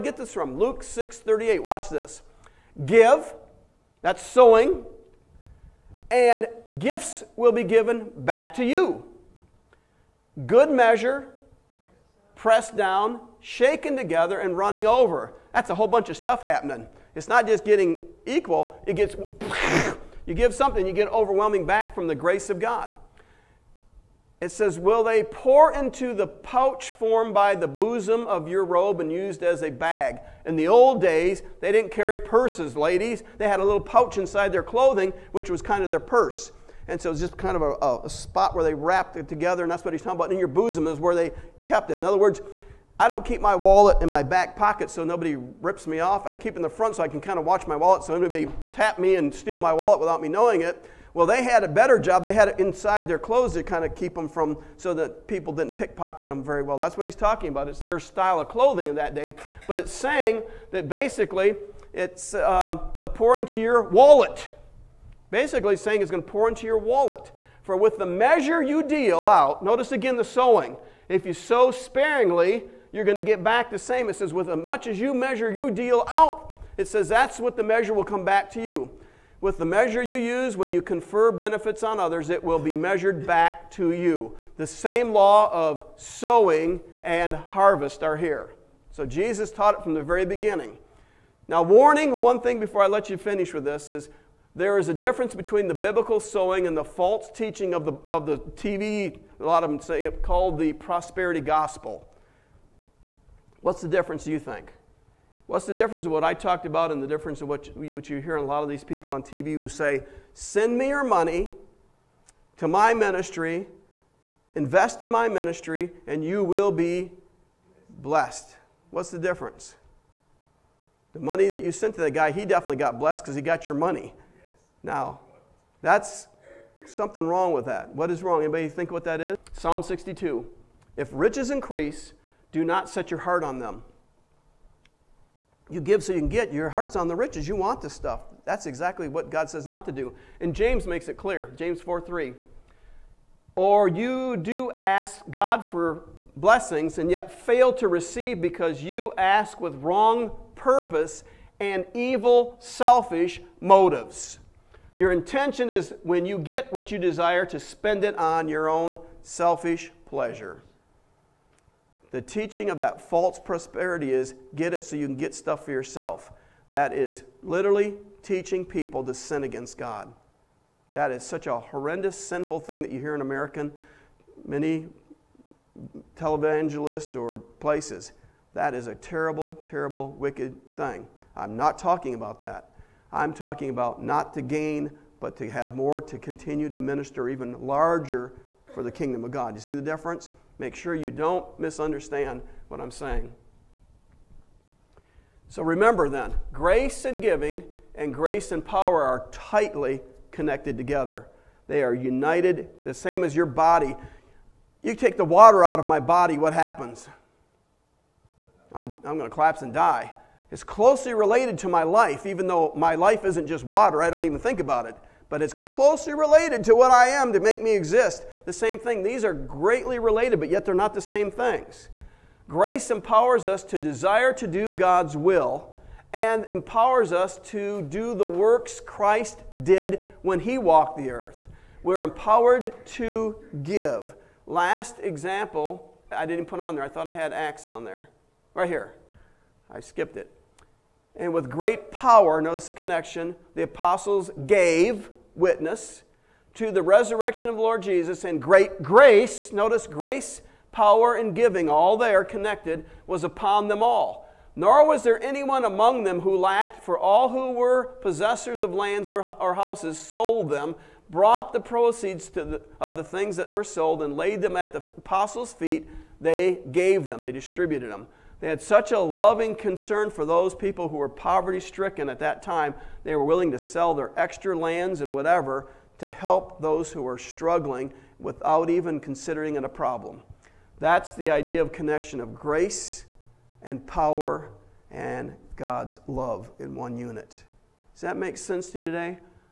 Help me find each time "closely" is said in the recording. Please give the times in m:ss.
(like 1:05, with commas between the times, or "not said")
3:30, 3:35.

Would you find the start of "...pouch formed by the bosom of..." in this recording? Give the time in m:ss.
0:26.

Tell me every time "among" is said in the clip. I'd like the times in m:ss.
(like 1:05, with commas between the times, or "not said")
4:15.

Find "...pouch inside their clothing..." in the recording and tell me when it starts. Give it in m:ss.
0:33.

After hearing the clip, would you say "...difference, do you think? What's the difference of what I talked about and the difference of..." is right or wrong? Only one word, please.
right.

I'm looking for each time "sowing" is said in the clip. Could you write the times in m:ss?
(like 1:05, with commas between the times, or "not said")
0:04, 1:10, 1:25, 1:36.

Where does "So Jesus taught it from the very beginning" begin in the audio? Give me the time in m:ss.
1:28.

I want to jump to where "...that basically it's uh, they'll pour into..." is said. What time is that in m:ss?
1:00.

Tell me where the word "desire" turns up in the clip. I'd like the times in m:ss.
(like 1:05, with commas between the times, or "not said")
2:36, 3:43.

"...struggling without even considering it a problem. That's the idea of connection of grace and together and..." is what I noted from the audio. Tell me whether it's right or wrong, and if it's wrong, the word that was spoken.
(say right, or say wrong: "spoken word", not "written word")
wrong: "power", not "together".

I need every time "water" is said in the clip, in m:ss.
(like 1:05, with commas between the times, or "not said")
3:25, 3:33.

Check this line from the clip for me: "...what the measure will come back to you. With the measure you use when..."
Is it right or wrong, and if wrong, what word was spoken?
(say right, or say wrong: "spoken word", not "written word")
right.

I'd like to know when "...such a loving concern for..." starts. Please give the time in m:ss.
4:28.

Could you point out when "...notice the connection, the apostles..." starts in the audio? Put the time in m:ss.
4:02.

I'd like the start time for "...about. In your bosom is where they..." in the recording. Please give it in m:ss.
0:40.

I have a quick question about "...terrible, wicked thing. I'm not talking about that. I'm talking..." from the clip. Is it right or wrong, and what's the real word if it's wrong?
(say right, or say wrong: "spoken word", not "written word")
right.